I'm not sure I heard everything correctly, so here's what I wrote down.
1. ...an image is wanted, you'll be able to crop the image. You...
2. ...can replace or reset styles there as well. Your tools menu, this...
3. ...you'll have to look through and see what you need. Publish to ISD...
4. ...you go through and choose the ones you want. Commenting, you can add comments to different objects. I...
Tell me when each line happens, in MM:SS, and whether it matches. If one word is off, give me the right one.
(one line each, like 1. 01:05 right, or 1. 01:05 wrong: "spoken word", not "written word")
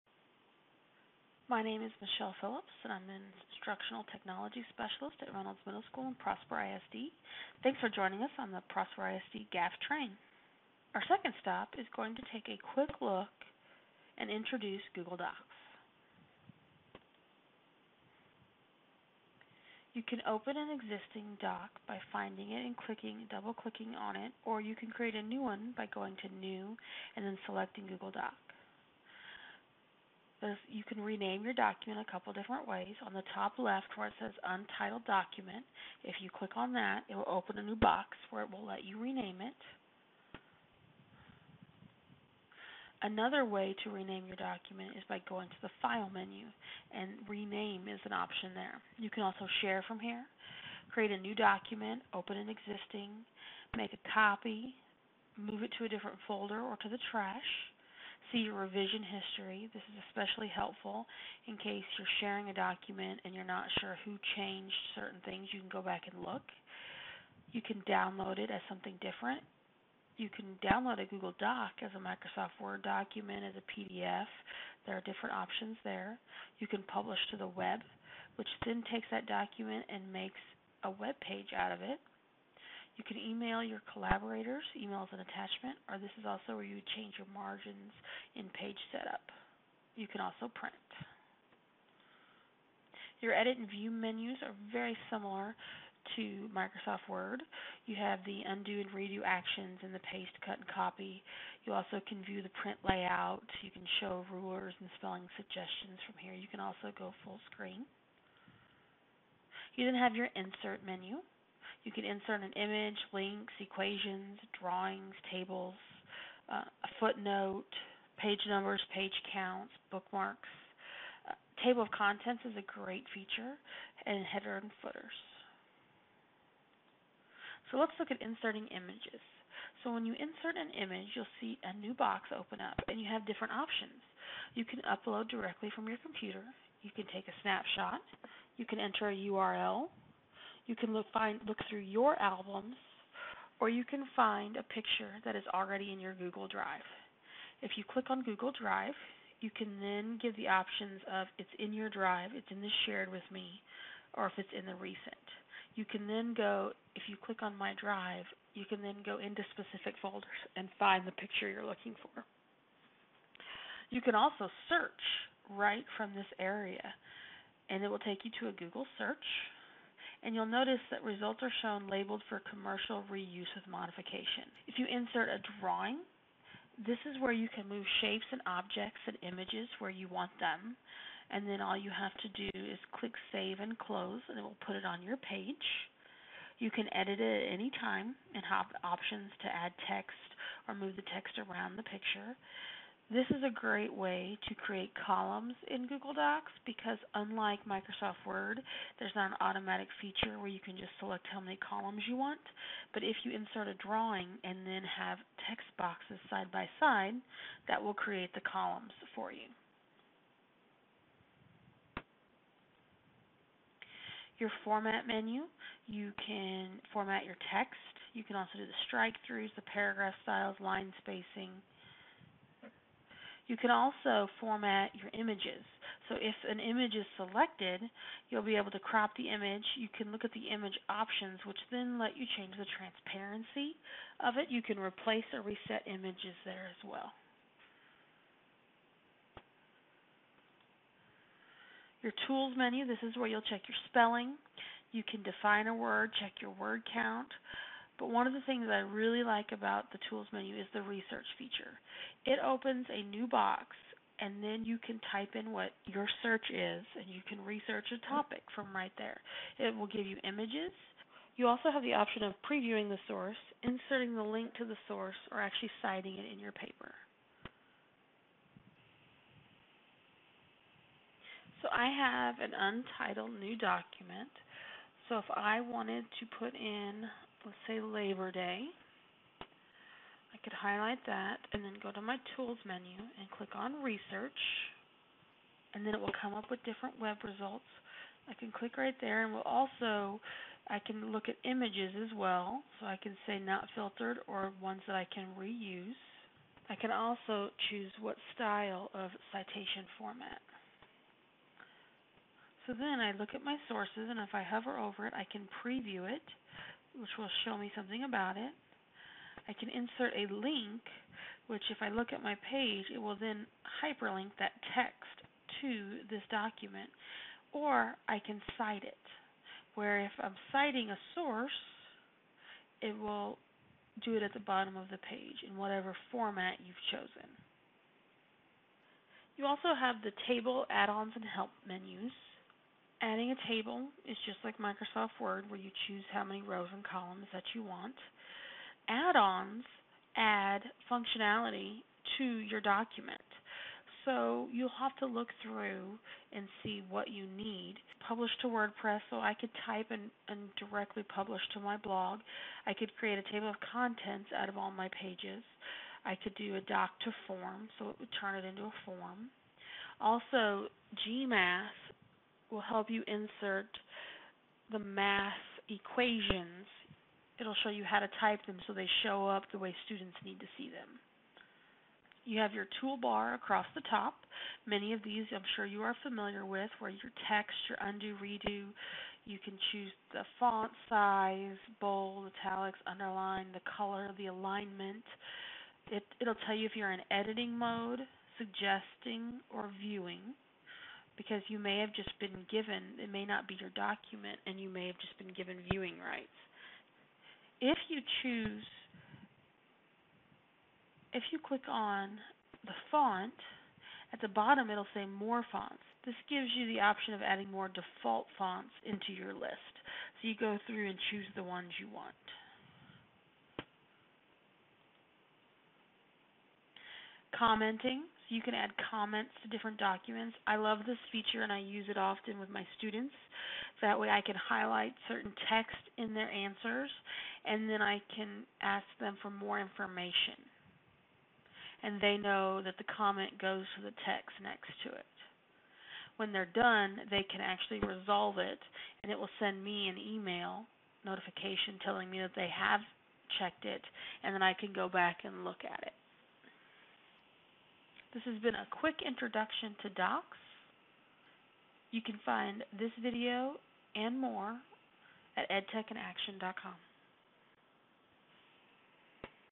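1. 03:46 wrong: "selected", not "wanted"
2. 03:54 wrong: "images", not "styles"
3. 05:44 wrong: "WordPress", not "ISD"
4. 06:50 wrong: "documents", not "objects".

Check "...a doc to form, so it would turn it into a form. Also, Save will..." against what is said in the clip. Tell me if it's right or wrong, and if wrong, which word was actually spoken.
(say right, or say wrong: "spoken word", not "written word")
wrong: "GMath", not "Save".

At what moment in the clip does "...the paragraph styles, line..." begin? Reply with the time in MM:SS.
03:39.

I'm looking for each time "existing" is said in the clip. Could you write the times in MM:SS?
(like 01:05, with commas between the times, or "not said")
00:20, 00:52.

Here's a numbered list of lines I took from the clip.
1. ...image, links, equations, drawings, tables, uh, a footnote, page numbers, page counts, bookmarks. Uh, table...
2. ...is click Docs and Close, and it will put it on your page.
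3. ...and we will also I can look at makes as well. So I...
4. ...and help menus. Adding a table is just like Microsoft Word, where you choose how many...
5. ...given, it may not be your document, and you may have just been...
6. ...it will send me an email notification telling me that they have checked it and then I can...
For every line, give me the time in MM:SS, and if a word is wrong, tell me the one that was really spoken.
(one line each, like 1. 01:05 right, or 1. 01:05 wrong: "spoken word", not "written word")
1. 01:52 right
2. 03:02 wrong: "Save", not "Docs"
3. 04:49 wrong: "images", not "makes"
4. 05:31 right
5. 06:32 right
6. 07:19 right.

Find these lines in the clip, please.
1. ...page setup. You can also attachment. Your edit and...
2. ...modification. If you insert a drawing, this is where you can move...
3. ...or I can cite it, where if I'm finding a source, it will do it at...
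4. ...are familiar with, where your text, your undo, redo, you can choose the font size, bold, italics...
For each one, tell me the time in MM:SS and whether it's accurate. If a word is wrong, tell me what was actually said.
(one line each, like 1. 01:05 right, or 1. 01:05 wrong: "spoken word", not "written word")
1. 01:28 wrong: "print", not "attachment"
2. 02:53 right
3. 05:17 wrong: "citing", not "finding"
4. 06:15 right.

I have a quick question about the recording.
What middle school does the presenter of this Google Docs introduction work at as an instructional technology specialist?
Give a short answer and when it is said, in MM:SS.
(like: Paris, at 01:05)
Reynolds Middle School, at 00:05.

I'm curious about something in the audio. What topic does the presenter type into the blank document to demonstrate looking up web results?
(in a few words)
Labor Day.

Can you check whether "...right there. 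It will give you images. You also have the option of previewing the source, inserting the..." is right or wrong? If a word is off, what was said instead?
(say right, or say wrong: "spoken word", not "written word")
right.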